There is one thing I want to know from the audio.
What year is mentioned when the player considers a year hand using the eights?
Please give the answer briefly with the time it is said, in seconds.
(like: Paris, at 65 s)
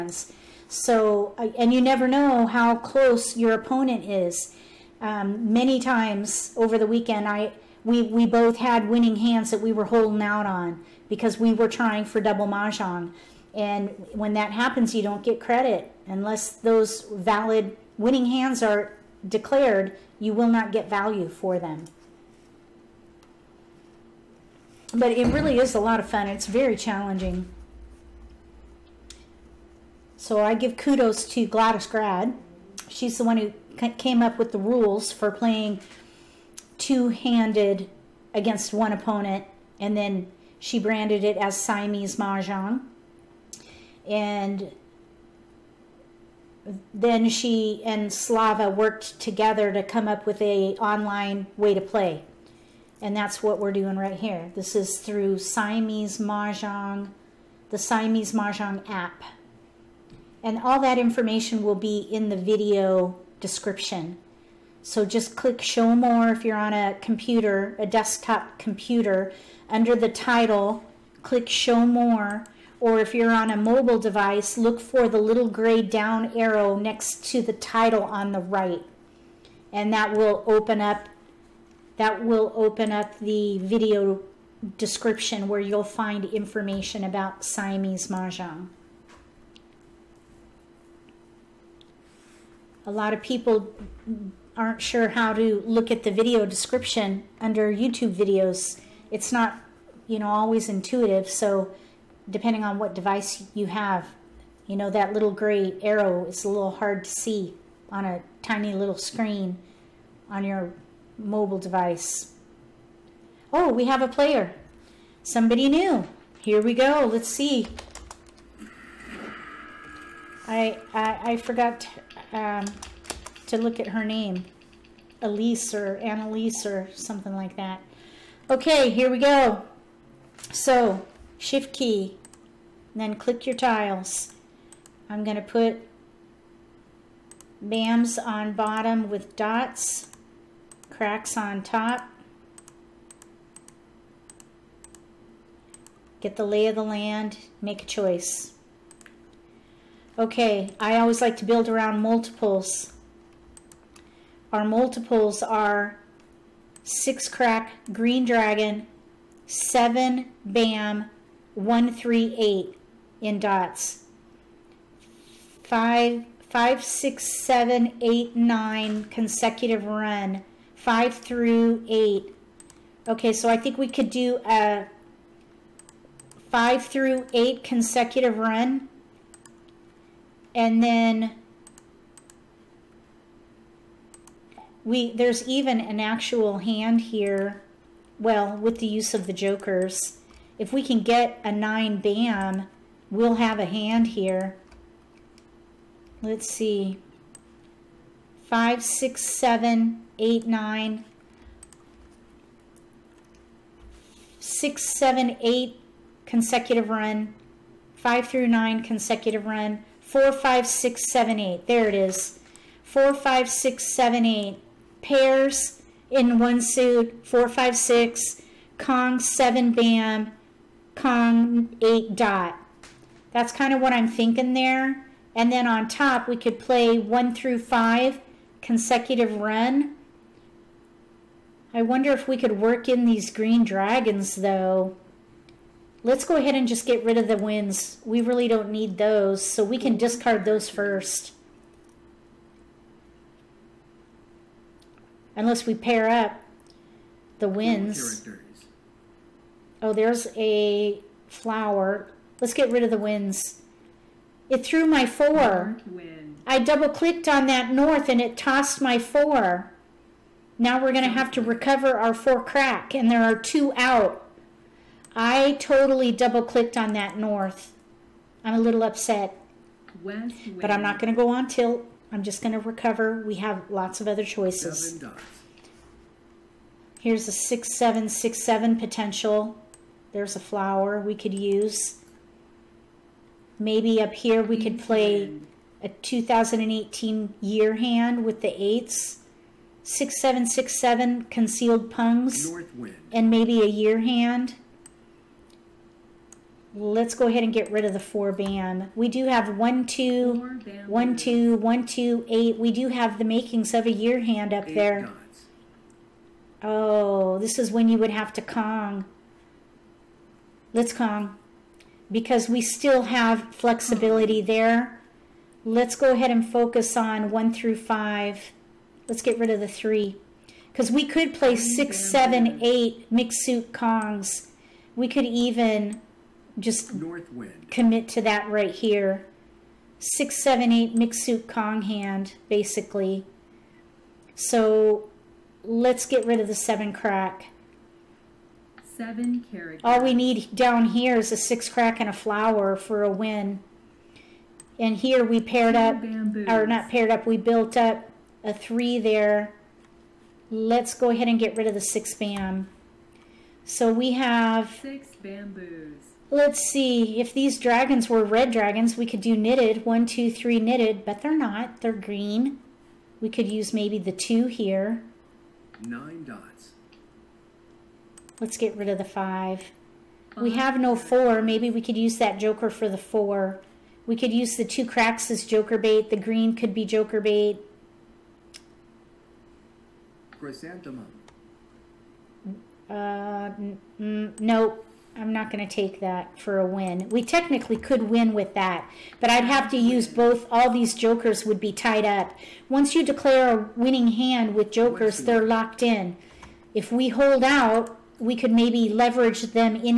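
2018, at 285 s.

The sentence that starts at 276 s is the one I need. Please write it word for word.
Here's a six seven six seven potential.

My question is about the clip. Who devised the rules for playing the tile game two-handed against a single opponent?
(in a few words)
Gladys Grad.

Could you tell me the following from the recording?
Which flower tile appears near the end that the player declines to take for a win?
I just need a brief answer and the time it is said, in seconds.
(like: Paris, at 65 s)
Chrysanthemum, at 380 s.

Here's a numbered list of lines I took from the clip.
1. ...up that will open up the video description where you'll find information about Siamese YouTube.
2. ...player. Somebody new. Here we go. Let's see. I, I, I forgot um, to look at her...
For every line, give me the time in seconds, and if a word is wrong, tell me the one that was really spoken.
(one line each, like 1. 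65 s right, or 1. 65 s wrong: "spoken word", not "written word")
1. 80 s wrong: "Mahjong", not "YouTube"
2. 114 s right.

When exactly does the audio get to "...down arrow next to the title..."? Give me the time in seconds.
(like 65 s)
75 s.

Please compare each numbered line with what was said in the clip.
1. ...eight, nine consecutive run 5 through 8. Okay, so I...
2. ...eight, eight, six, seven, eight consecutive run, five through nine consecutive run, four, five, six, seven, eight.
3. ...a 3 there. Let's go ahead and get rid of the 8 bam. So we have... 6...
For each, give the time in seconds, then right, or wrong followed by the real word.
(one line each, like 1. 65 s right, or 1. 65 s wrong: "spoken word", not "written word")
1. 168 s right
2. 200 s wrong: "nine", not "eight"
3. 348 s wrong: "6", not "8".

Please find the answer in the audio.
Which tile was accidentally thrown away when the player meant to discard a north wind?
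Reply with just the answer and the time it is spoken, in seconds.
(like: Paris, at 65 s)
4 crack, at 262 s.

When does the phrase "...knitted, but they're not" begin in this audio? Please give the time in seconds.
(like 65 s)
360 s.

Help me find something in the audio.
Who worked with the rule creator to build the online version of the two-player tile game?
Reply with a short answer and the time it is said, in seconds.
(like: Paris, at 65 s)
Slava, at 48 s.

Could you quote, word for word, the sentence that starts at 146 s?
Get the lay of the land, make a choice.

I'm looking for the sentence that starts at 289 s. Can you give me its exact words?
6767 Concealed Pungs and maybe a year hand.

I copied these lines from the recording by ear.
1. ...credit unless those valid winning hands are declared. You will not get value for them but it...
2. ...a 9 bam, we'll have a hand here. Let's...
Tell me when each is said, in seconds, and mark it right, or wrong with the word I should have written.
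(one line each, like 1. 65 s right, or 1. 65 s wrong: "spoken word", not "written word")
1. 15 s right
2. 191 s right.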